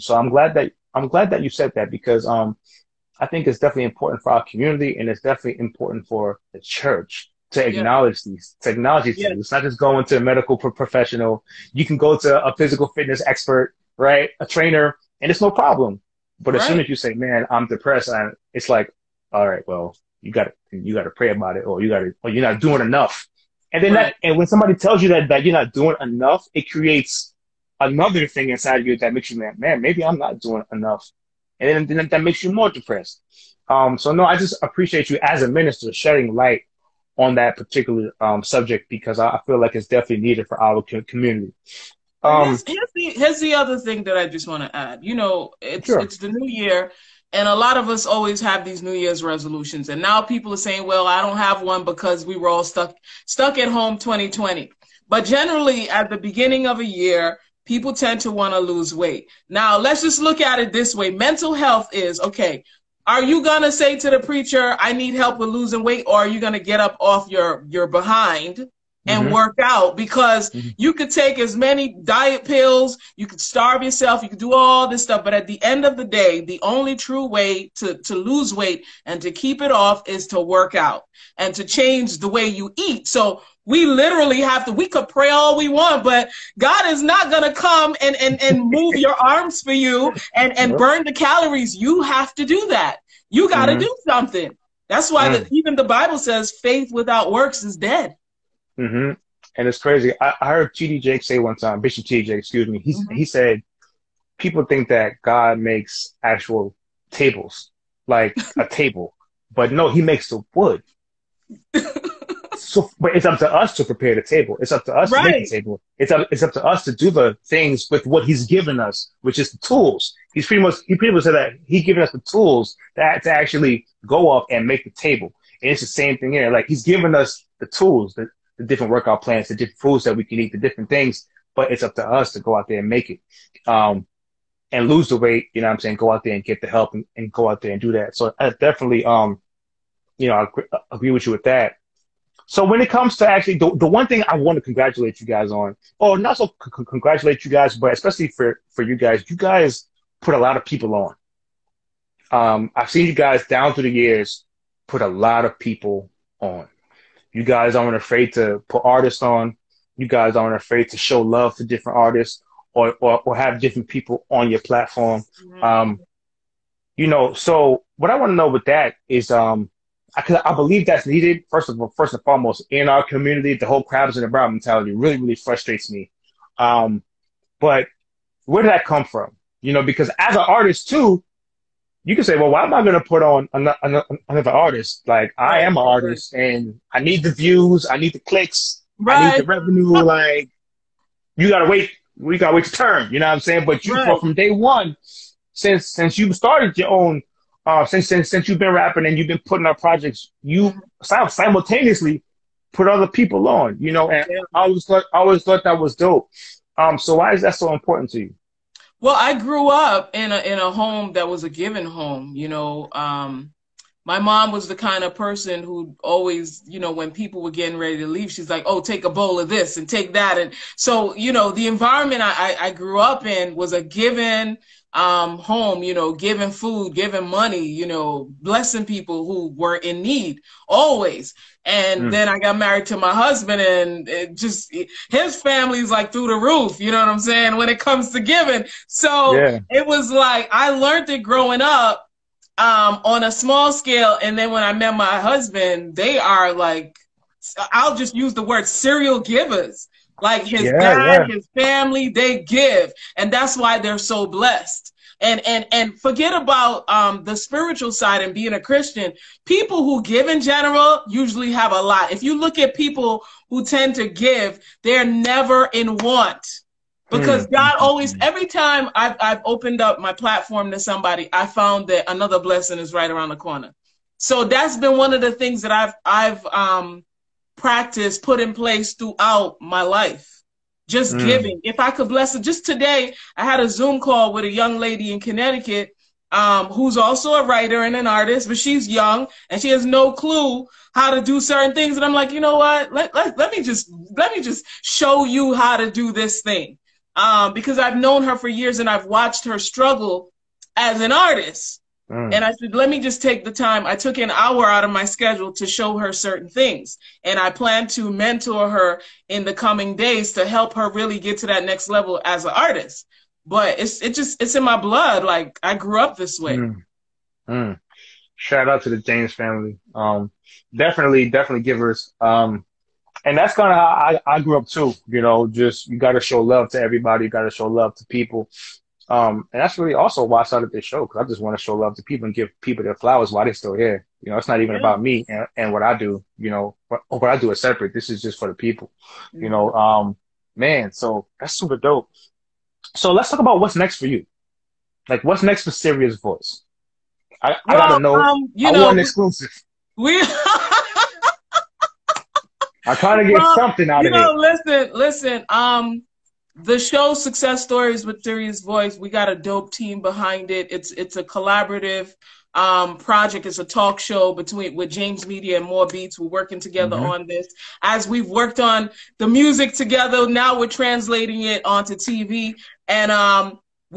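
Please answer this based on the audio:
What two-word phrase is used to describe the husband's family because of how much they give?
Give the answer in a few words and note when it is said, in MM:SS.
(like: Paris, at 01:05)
serial givers, at 04:08.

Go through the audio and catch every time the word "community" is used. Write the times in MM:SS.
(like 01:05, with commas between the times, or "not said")
00:04, 00:41, 02:53.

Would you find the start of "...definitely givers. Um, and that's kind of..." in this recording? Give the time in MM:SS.
05:21.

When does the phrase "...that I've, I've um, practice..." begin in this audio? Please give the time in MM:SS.
04:35.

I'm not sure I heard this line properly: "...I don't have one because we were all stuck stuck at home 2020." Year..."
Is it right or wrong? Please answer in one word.
wrong.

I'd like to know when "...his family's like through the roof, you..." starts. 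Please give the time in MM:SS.
03:55.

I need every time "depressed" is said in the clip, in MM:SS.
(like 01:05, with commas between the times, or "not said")
00:17, 00:32.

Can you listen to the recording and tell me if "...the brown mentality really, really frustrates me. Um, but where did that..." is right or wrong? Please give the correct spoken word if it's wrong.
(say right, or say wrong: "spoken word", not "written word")
right.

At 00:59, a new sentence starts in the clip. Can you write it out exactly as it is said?
Now, let's just look at it this way: mental health is okay.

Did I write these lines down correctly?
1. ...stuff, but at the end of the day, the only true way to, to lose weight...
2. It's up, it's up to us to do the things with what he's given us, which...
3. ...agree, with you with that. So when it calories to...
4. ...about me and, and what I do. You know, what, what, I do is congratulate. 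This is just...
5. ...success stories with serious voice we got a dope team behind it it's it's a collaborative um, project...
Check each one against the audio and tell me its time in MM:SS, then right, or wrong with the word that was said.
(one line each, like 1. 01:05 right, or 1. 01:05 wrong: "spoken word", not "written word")
1. 01:15 right
2. 01:55 right
3. 02:20 wrong: "comes", not "calories"
4. 05:34 wrong: "separate", not "congratulate"
5. 05:57 right.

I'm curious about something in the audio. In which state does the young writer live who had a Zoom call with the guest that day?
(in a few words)
Connecticut.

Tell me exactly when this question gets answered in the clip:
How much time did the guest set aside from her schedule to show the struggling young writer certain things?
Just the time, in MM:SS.
05:04.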